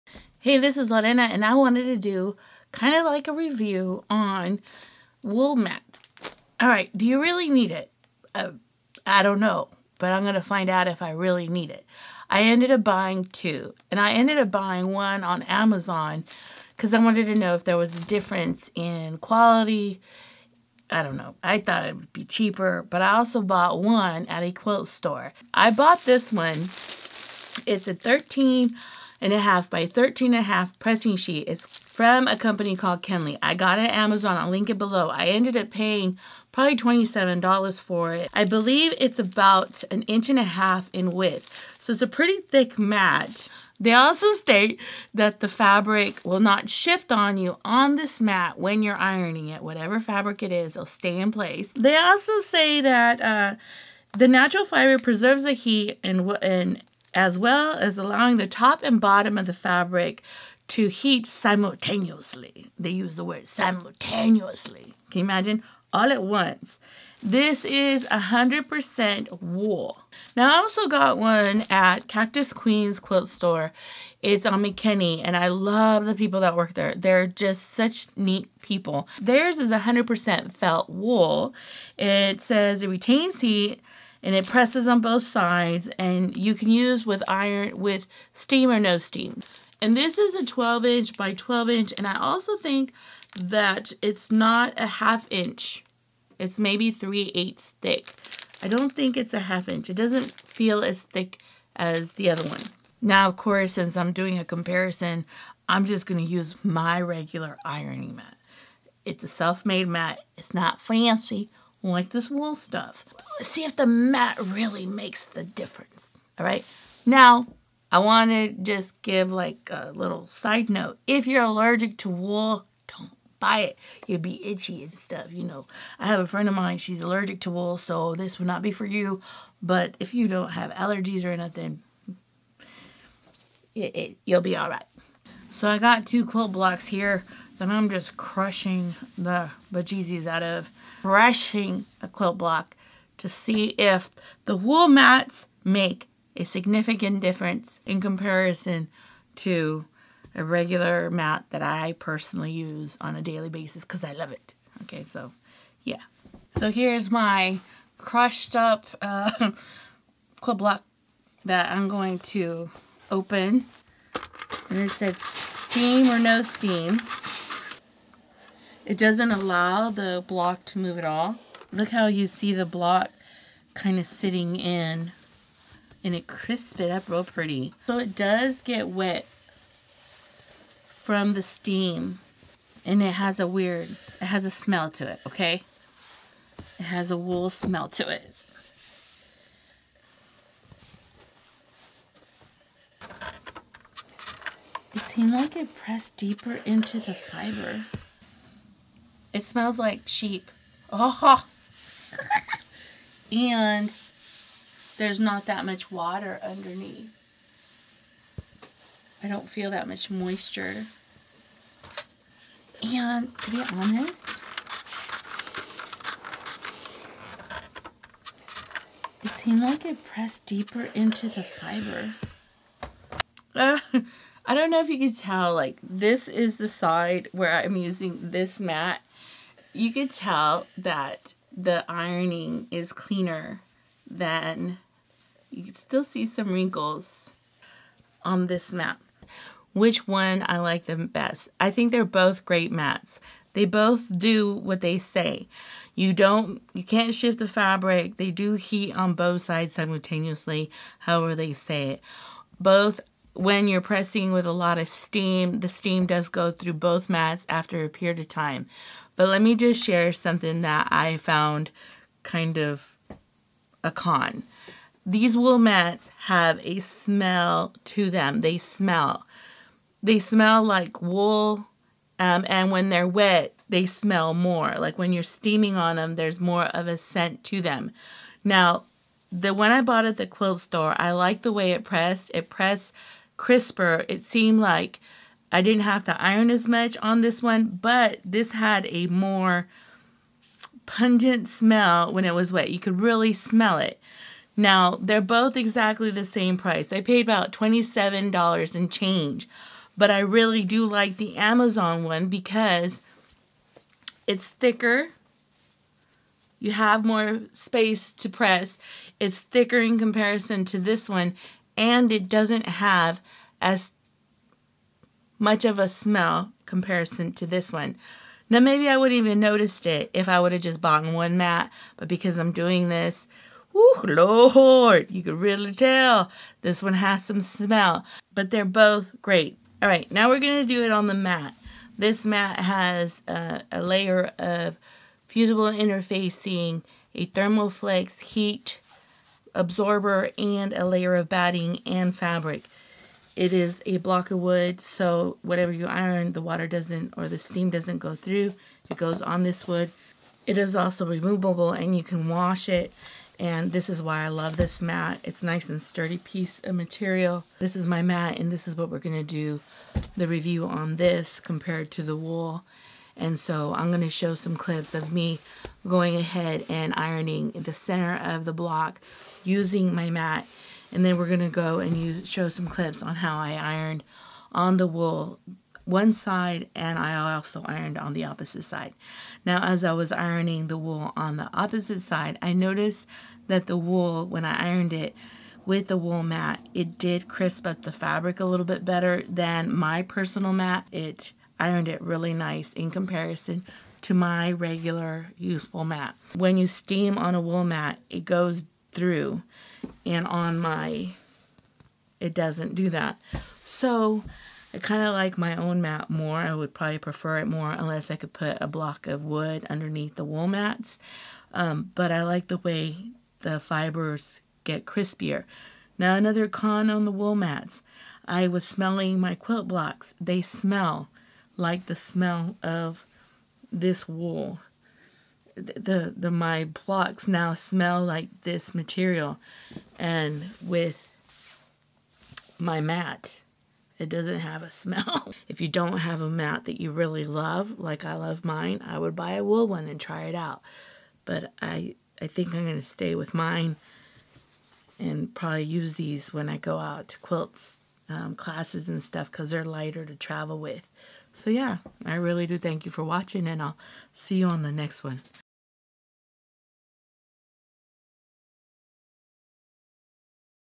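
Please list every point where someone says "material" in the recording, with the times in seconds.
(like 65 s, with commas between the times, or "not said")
356 s, 428 s.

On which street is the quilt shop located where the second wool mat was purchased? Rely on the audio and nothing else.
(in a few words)
McKinney.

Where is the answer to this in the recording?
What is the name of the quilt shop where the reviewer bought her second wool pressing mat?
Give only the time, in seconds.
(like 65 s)
72 s.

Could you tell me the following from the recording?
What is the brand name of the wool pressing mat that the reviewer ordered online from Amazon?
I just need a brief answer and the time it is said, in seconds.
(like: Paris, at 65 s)
Kenley, at 33 s.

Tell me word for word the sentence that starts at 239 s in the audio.
Which one I like the best?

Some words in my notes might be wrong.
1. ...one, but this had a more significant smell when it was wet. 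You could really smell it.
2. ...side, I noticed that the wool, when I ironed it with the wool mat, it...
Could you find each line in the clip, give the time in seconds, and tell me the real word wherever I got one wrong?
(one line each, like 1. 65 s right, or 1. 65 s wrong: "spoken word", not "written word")
1. 287 s wrong: "pungent", not "significant"
2. 382 s right.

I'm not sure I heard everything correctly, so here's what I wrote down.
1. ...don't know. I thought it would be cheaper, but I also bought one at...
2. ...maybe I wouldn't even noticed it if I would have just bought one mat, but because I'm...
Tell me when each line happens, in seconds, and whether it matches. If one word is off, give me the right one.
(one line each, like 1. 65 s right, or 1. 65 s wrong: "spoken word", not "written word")
1. 21 s right
2. 318 s right.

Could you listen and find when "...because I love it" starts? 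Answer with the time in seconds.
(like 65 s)
153 s.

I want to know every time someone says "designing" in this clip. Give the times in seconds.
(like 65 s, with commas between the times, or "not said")
not said.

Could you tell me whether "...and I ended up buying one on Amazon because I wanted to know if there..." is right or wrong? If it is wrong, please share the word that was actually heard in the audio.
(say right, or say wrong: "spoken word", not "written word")
right.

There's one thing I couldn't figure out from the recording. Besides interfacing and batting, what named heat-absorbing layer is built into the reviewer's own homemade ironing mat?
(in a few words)
Thermoflex.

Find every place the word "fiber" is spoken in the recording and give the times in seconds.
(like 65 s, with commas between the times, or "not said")
54 s, 197 s, 221 s, 413 s.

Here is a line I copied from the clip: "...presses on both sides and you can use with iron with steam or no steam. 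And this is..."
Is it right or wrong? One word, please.
right.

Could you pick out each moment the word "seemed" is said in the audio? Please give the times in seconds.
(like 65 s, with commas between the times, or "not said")
195 s, 219 s, 284 s.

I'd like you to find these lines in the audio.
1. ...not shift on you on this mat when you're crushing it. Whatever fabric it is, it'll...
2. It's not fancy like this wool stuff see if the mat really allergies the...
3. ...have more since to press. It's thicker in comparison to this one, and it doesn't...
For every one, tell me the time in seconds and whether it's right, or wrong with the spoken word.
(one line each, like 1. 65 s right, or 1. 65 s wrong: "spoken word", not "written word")
1. 46 s wrong: "ironing", not "crushing"
2. 110 s wrong: "makes", not "allergies"
3. 306 s wrong: "space", not "since".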